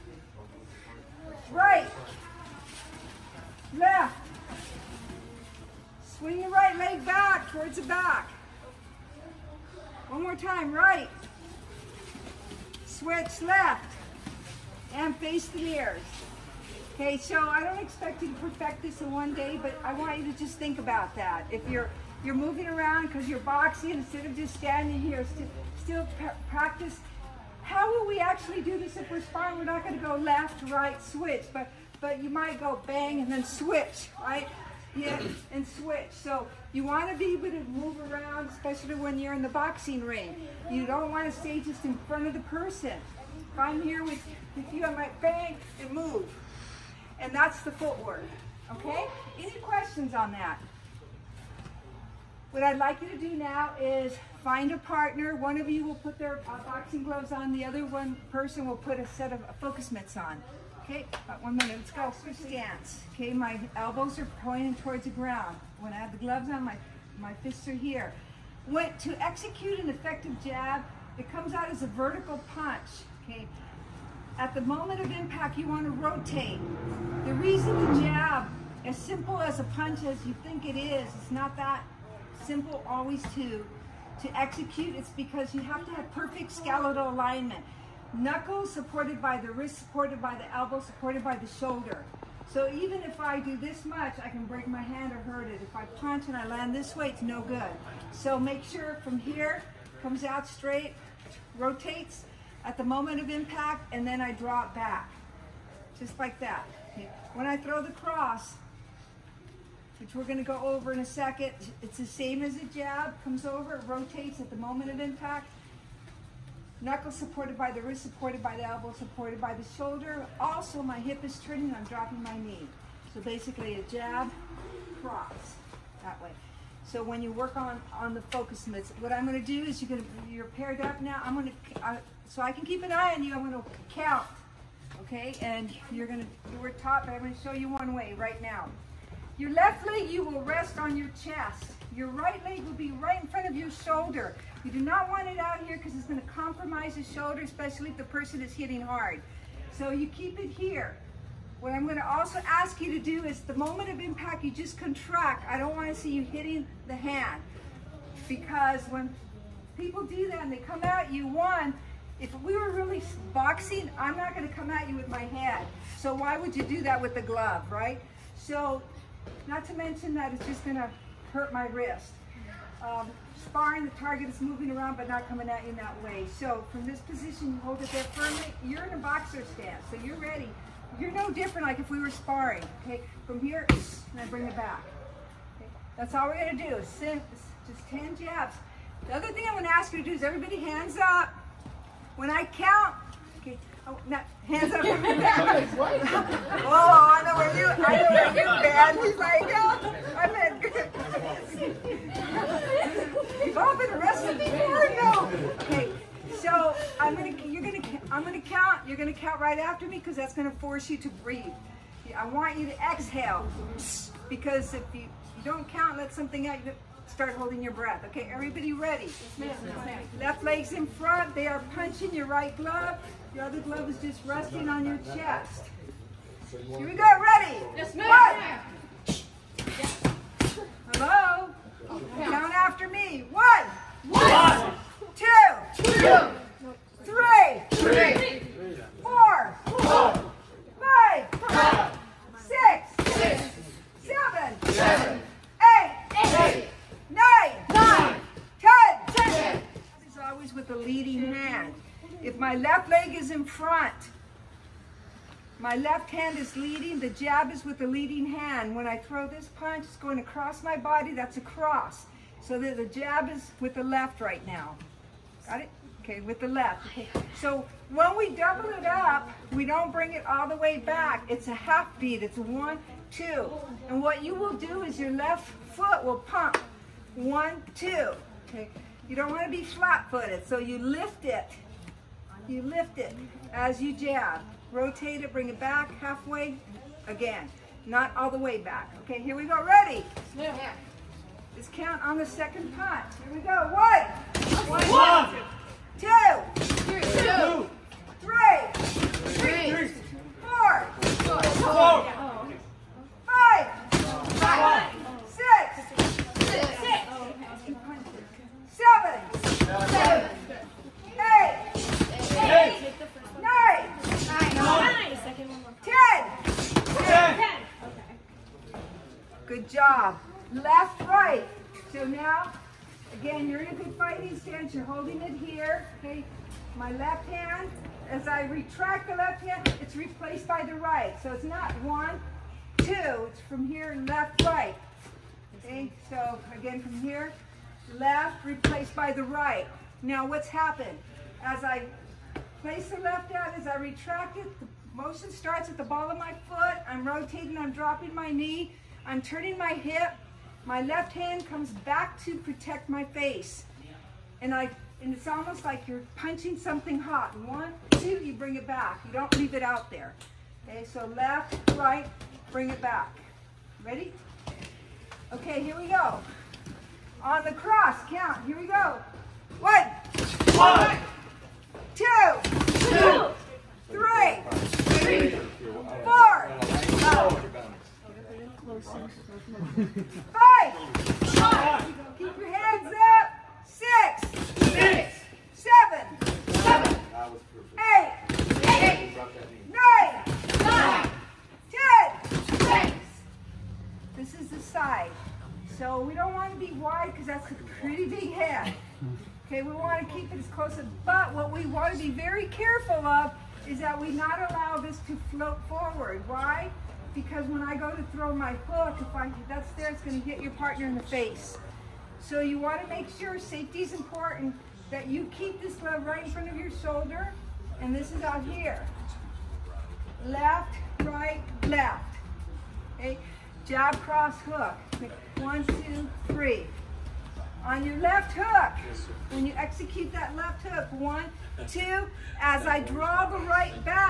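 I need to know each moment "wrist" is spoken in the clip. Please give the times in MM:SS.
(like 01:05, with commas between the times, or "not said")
01:29, 01:57, 02:51.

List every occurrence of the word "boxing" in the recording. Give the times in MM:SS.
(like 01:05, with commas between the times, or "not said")
00:23, 00:39, 00:56, 02:43.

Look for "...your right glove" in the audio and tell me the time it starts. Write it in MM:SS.
03:42.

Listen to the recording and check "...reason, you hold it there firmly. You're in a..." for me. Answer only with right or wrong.
wrong.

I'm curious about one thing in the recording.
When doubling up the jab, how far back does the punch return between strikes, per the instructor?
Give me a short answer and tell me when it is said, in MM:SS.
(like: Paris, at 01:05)
half beat, at 04:31.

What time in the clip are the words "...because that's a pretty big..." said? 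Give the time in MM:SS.
06:37.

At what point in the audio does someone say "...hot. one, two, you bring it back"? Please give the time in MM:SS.
05:56.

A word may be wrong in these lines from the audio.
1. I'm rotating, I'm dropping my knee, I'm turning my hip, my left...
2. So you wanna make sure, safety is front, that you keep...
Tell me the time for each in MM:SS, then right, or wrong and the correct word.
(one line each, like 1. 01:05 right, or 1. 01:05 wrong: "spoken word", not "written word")
1. 05:46 right
2. 06:52 wrong: "important", not "front".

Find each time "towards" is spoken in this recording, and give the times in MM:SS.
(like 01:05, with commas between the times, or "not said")
00:07, 01:04.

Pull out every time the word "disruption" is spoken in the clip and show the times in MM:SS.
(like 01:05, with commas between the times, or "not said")
not said.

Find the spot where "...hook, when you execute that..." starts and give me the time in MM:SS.
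07:08.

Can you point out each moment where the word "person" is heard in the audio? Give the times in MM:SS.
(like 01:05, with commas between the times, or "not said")
00:42, 00:58, 02:28.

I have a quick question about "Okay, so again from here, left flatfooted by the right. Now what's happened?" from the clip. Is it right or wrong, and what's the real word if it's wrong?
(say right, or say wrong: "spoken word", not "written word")
wrong: "replaced", not "flatfooted".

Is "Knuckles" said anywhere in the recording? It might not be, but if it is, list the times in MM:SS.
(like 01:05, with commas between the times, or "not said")
01:28, 01:56.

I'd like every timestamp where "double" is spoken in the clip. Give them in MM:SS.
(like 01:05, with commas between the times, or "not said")
04:28.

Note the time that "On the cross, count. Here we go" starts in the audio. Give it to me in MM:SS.
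06:07.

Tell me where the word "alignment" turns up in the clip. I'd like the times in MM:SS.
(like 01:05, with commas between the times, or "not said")
01:27.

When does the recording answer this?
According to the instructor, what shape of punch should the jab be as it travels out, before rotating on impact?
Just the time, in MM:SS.
01:11.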